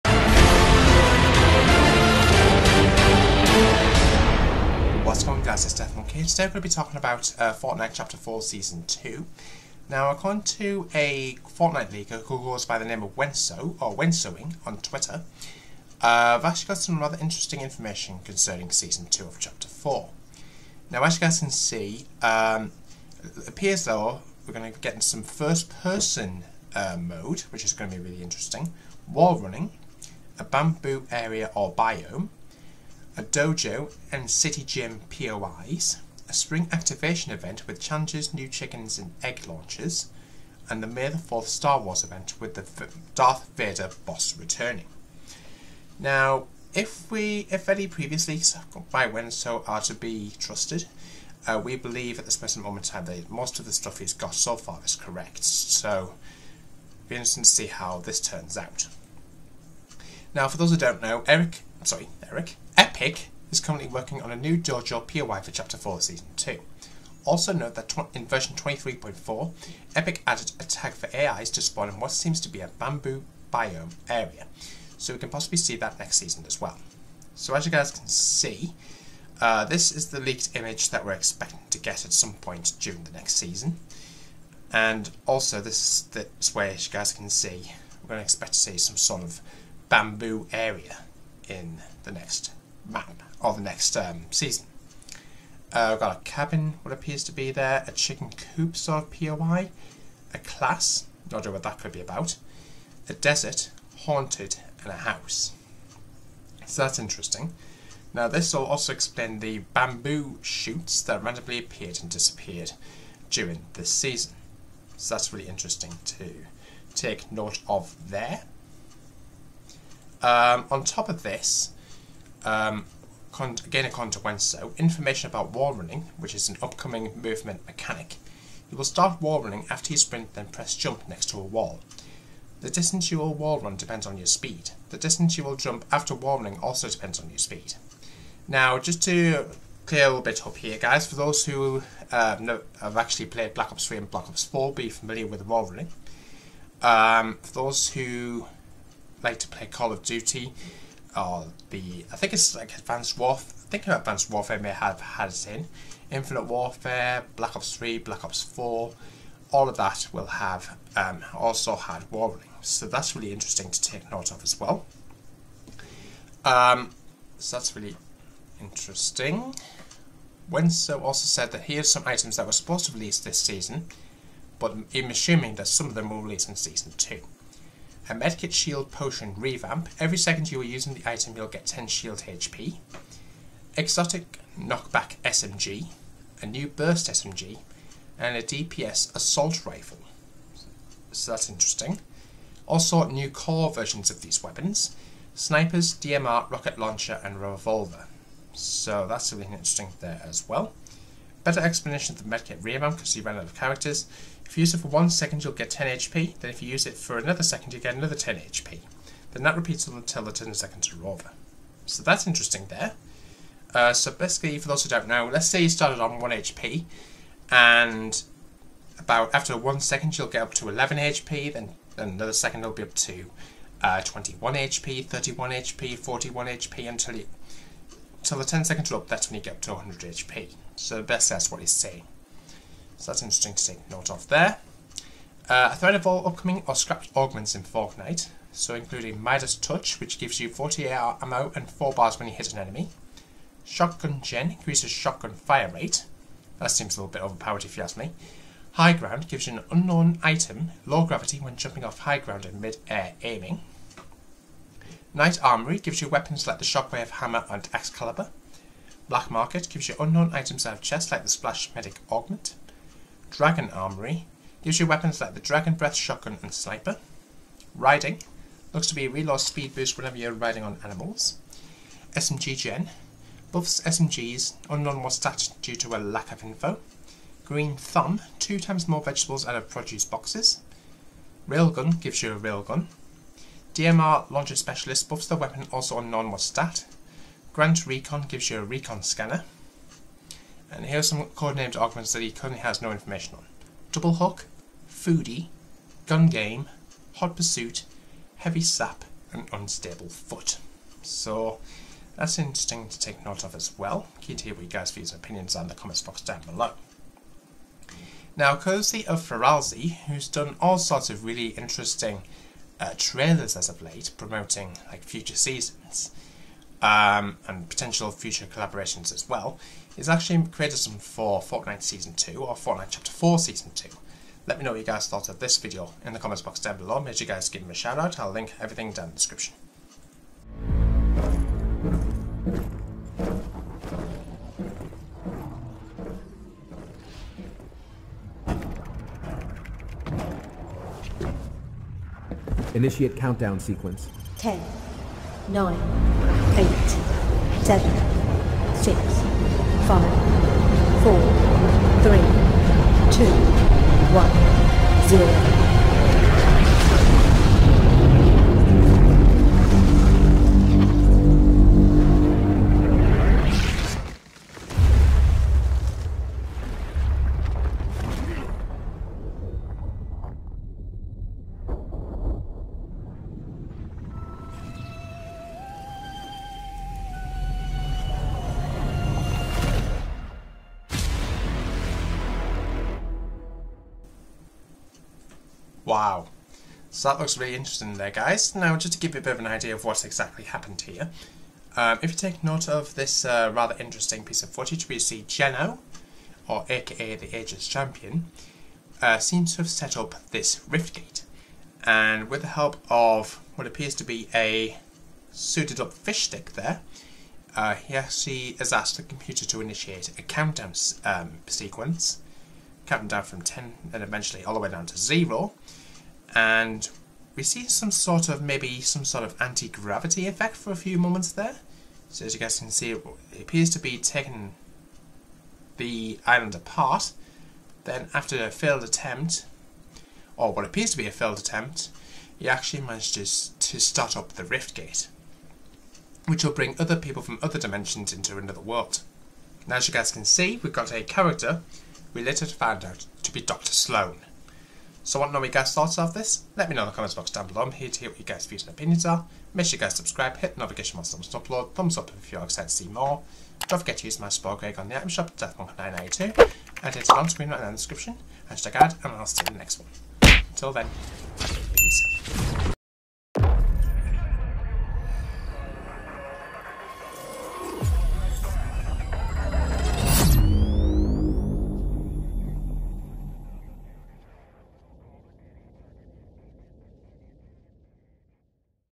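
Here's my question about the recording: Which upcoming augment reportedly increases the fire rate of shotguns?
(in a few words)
Shotgun Gen.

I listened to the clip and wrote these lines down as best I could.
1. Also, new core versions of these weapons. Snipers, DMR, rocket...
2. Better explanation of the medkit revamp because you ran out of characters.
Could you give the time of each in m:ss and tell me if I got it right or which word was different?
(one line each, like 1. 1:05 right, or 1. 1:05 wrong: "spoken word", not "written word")
1. 3:12 right
2. 3:21 right.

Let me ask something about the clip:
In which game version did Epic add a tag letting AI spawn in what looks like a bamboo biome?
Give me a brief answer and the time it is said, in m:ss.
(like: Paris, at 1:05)
23.4, at 1:08.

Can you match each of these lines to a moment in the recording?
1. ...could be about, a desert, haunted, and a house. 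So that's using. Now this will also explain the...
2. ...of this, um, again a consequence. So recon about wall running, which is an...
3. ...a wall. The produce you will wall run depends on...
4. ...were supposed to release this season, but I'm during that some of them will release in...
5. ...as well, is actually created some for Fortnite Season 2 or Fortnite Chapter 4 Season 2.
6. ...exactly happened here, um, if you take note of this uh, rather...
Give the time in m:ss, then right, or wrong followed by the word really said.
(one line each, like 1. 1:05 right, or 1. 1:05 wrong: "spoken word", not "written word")
1. 1:41 wrong: "interesting", not "using"
2. 2:01 wrong: "information", not "recon"
3. 2:11 wrong: "distance", not "produce"
4. 2:52 wrong: "assuming", not "during"
5. 5:19 right
6. 6:30 right.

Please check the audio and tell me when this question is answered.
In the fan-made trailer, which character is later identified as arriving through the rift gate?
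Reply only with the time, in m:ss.
7:23.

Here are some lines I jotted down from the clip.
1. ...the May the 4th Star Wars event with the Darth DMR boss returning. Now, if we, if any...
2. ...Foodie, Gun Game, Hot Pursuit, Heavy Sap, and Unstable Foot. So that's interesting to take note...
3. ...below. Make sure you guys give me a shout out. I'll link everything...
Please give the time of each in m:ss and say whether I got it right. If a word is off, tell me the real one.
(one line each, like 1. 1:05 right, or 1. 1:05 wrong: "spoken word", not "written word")
1. 0:40 wrong: "Vader", not "DMR"
2. 4:54 right
3. 5:26 right.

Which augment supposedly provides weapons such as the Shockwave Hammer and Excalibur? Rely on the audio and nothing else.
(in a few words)
Knight Armory.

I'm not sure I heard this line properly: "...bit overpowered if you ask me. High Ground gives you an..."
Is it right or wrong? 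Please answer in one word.
right.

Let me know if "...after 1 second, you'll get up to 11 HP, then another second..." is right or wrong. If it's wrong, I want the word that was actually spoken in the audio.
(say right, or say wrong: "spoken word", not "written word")
right.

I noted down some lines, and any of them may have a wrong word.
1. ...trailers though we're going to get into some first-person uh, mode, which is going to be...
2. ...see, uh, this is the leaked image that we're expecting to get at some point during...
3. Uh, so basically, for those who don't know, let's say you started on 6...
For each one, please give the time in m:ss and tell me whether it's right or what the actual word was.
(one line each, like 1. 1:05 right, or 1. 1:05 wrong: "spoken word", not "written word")
1. 0:23 wrong: "appears", not "trailers"
2. 1:18 right
3. 3:33 wrong: "1", not "6".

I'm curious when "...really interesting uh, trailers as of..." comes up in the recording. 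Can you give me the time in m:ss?
5:11.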